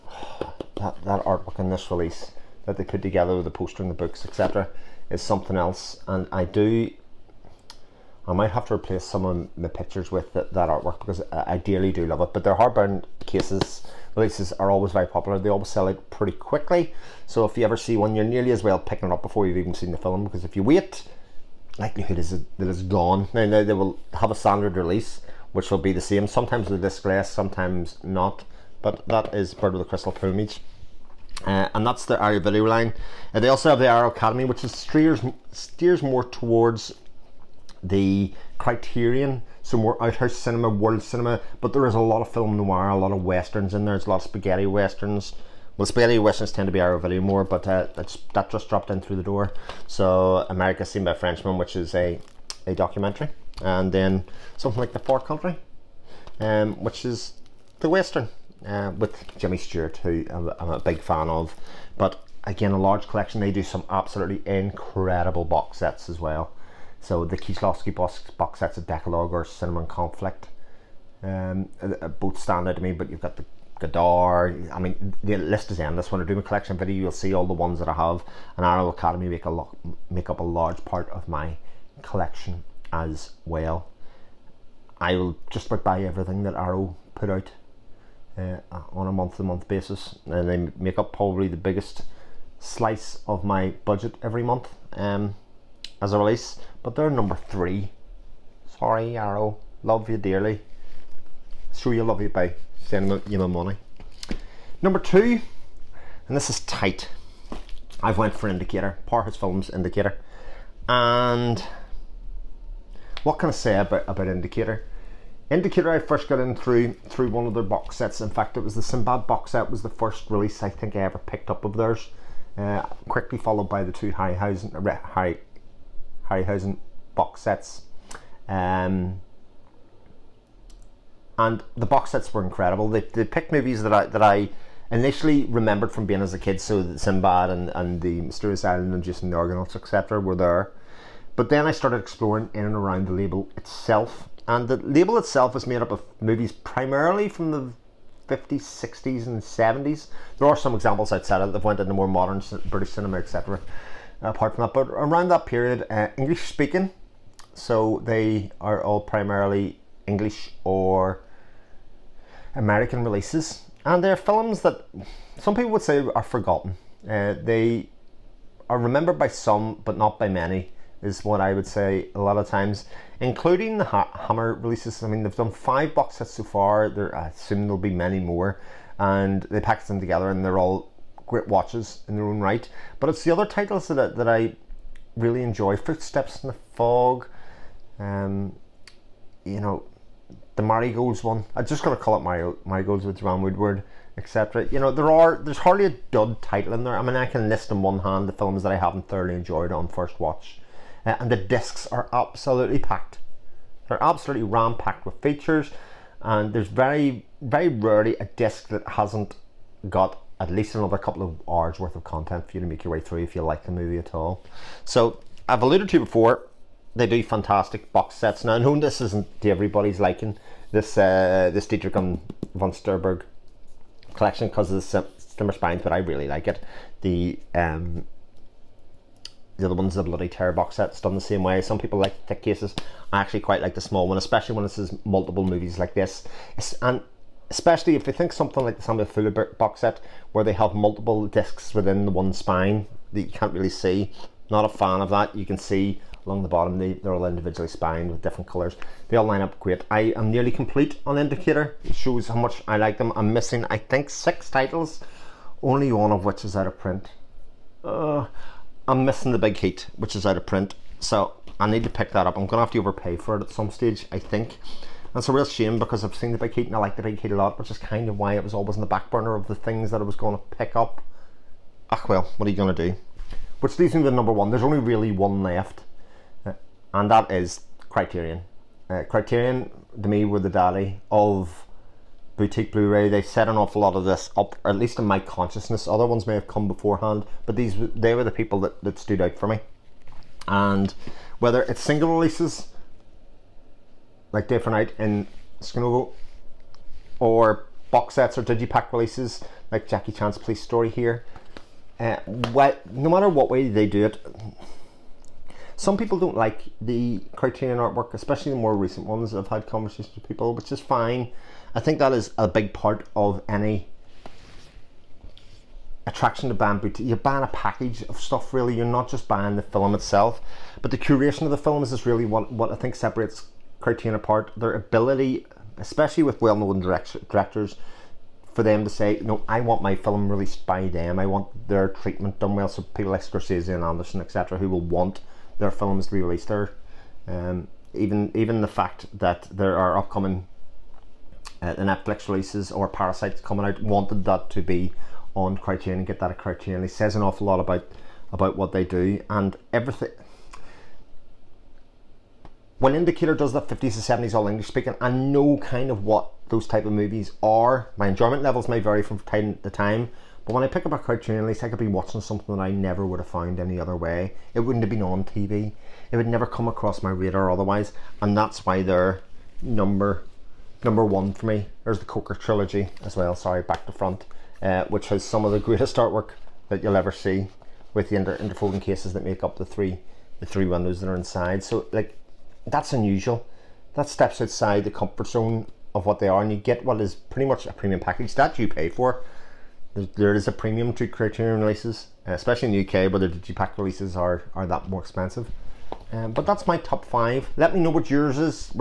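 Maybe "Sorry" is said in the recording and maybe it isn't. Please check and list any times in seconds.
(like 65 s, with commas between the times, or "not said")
98 s, 373 s.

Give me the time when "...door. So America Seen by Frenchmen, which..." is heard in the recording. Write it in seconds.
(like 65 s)
49 s.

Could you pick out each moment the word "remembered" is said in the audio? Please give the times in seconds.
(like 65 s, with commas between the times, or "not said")
135 s, 168 s.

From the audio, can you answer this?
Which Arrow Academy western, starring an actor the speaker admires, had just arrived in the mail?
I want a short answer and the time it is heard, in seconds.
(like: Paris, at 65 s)
The Far Country, at 54 s.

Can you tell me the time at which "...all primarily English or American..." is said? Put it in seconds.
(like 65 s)
158 s.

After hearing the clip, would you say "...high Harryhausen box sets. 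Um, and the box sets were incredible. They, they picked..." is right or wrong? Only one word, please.
right.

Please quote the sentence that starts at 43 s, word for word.
There's a lot of spaghetti westerns.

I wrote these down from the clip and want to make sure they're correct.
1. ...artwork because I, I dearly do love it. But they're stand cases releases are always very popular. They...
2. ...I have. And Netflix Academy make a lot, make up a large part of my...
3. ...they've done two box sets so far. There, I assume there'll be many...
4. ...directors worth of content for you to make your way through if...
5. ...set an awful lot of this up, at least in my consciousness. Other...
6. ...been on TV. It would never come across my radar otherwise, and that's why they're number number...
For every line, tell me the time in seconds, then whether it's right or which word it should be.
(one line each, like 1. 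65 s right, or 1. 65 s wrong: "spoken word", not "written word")
1. 10 s wrong: "hardbound", not "stand"
2. 77 s wrong: "Arrow", not "Netflix"
3. 175 s wrong: "five", not "two"
4. 211 s wrong: "hours", not "directors"
5. 283 s right
6. 364 s right.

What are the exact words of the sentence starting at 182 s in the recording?
But it's the other titles that, that I really enjoy.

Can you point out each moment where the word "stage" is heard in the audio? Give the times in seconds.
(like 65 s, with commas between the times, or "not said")
263 s.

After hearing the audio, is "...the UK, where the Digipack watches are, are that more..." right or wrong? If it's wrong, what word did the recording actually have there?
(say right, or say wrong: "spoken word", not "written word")
wrong: "releases", not "watches".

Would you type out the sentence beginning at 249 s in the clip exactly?
I am nearly complete on Indicator.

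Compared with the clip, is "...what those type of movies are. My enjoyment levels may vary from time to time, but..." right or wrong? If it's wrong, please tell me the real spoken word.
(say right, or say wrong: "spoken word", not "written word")
right.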